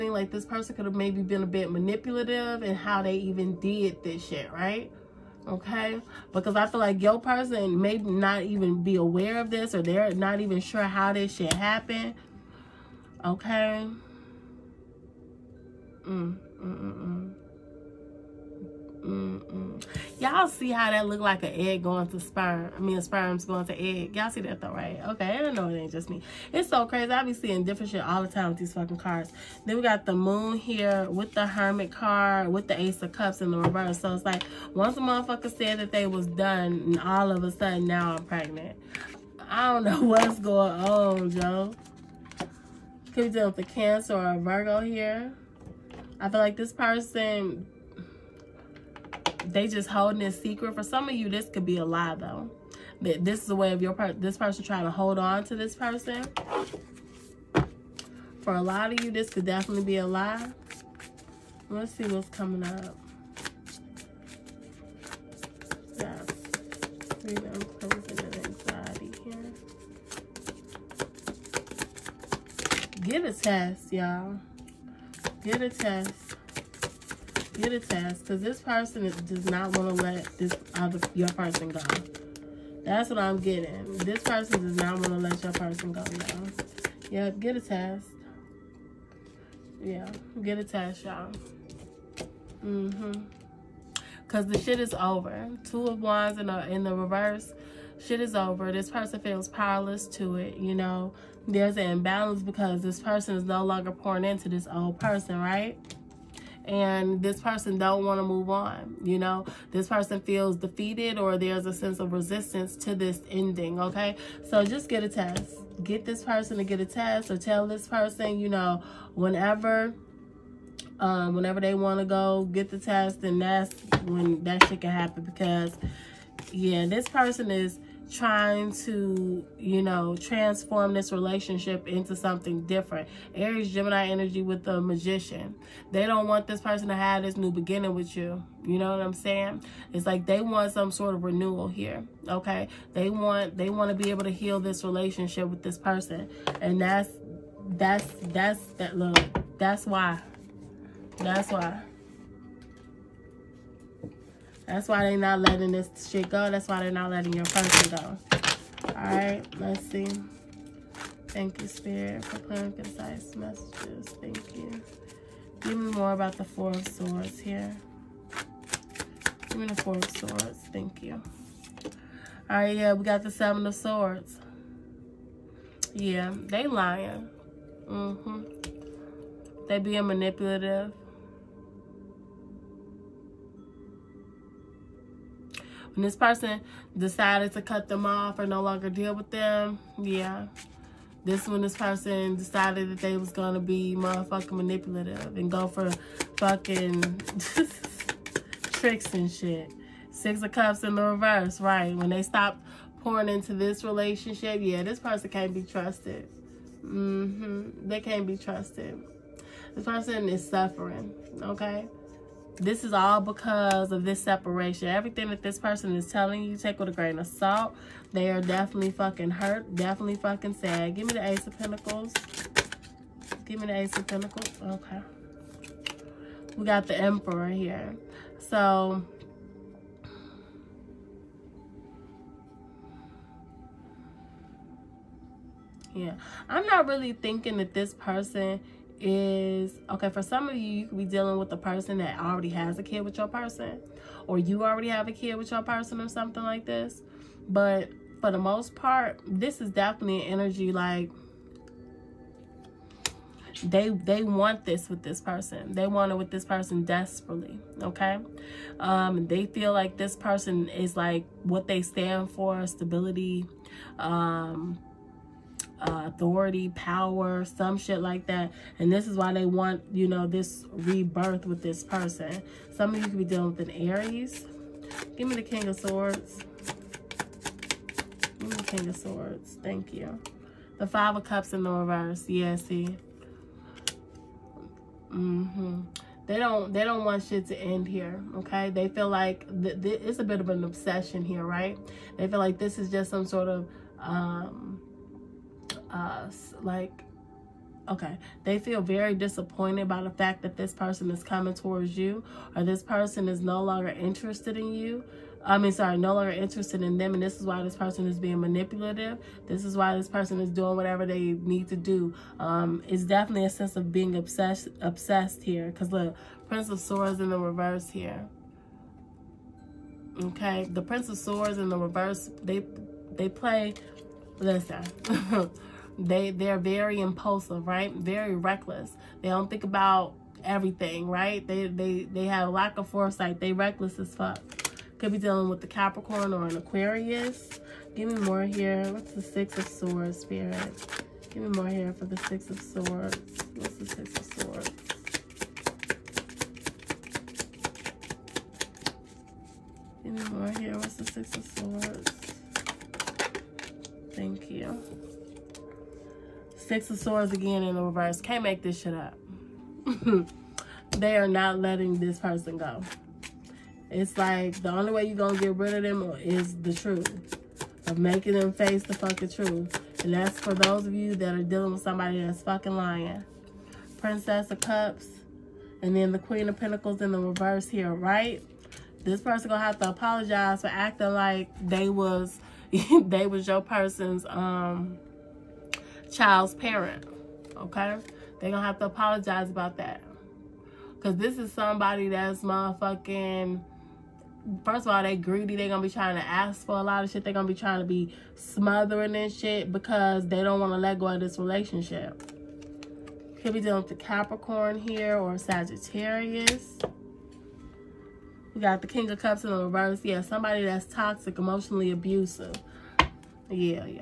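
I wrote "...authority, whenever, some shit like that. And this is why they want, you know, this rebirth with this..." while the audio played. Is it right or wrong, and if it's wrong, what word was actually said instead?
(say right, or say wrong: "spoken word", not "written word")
wrong: "power", not "whenever".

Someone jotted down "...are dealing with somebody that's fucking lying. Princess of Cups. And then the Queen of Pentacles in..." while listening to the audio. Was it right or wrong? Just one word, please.
right.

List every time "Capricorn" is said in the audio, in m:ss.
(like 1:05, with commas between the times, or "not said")
5:35, 6:44.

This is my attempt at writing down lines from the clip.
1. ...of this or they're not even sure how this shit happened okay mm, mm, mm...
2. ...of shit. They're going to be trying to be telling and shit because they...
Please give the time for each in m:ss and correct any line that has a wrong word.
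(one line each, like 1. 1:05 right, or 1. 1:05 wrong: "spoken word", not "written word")
1. 0:09 right
2. 6:37 wrong: "smothering", not "telling".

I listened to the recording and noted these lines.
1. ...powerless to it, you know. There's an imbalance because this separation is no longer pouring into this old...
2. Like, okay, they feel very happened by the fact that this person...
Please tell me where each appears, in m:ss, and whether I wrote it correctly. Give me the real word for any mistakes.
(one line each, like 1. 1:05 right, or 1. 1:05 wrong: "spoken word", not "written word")
1. 1:39 wrong: "person", not "separation"
2. 4:56 wrong: "disappointed", not "happened".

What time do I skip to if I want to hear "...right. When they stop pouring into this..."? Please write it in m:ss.
3:21.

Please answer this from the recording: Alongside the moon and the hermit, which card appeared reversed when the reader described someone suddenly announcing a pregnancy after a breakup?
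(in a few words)
Ace of Cups.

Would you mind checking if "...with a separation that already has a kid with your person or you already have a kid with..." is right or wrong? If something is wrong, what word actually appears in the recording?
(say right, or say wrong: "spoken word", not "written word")
wrong: "person", not "separation".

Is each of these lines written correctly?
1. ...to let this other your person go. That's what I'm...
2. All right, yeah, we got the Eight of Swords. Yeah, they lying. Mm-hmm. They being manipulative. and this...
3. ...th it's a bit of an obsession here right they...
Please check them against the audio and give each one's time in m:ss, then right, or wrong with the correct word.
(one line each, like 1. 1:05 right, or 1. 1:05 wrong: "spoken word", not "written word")
1. 1:19 right
2. 2:52 wrong: "Seven", not "Eight"
3. 4:49 right.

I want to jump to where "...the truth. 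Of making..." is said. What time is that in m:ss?
6:06.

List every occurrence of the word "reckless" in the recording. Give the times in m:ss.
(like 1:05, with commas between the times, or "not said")
5:28, 5:33.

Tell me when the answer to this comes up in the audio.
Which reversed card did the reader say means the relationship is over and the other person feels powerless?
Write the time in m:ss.
1:35.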